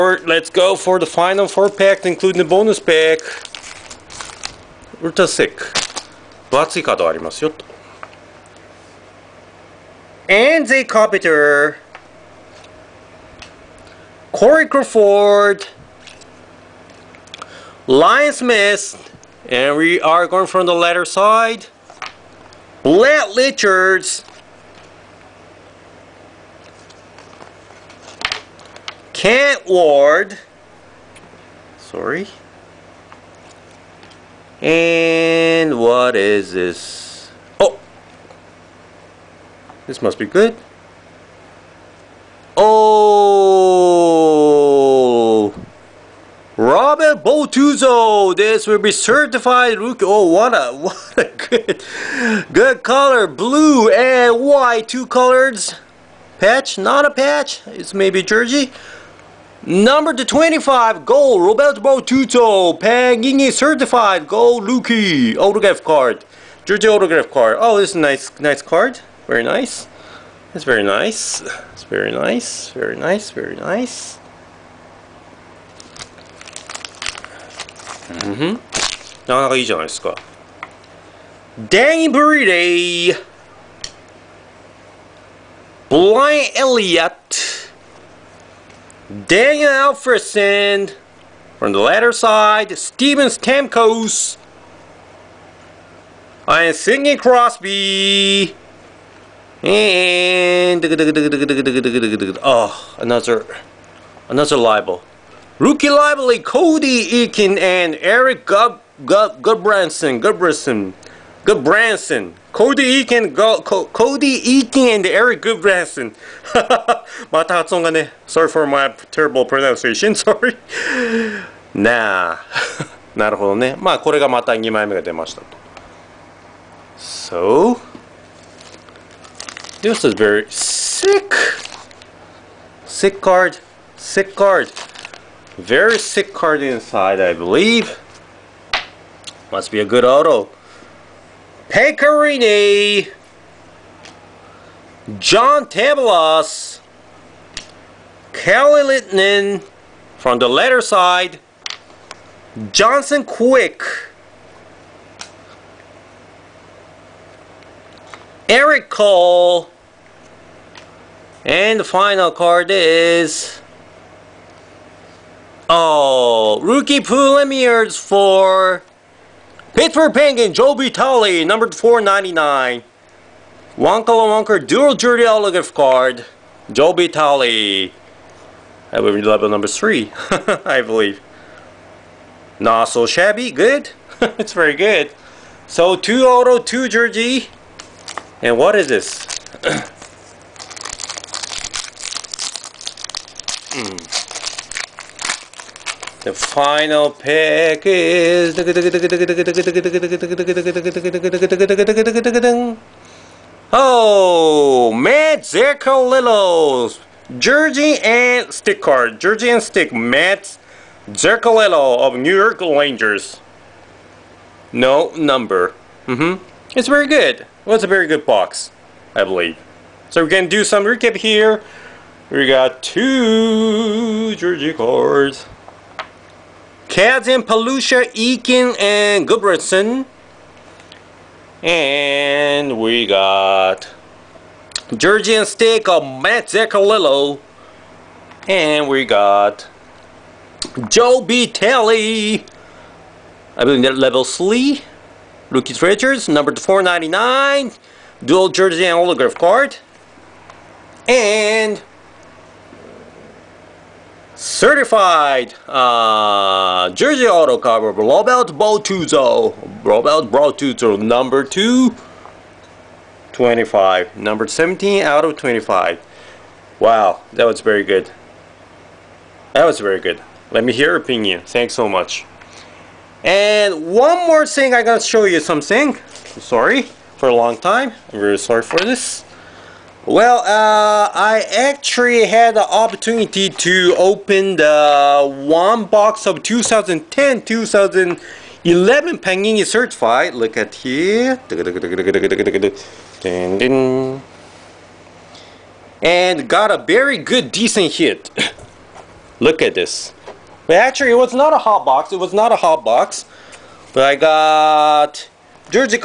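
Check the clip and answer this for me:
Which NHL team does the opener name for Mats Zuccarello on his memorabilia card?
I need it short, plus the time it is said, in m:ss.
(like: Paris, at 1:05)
New York Rangers, at 3:32.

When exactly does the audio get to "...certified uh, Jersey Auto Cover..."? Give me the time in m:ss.
4:14.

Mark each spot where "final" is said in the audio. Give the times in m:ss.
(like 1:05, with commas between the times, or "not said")
0:01, 2:41, 3:16.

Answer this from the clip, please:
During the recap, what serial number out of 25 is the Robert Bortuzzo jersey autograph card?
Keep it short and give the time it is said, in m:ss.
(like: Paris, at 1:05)
17, at 4:24.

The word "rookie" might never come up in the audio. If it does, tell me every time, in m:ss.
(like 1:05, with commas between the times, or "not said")
0:49, 1:04, 1:45, 2:46, 4:05.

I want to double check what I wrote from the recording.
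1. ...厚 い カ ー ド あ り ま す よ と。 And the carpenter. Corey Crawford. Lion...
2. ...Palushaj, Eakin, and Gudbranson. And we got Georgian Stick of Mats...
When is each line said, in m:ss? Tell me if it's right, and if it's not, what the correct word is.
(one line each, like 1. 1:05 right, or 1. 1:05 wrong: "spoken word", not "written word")
1. 0:06 right
2. 3:47 right.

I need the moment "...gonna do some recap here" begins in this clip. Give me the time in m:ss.
3:40.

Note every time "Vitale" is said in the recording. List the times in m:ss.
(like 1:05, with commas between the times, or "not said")
2:50, 2:56, 4:01.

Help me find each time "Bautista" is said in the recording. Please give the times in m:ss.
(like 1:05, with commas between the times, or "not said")
1:01.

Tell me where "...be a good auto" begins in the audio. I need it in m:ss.
2:19.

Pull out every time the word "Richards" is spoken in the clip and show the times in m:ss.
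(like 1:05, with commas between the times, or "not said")
0:23, 4:05.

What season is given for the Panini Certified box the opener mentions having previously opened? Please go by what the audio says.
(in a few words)
2010-2011.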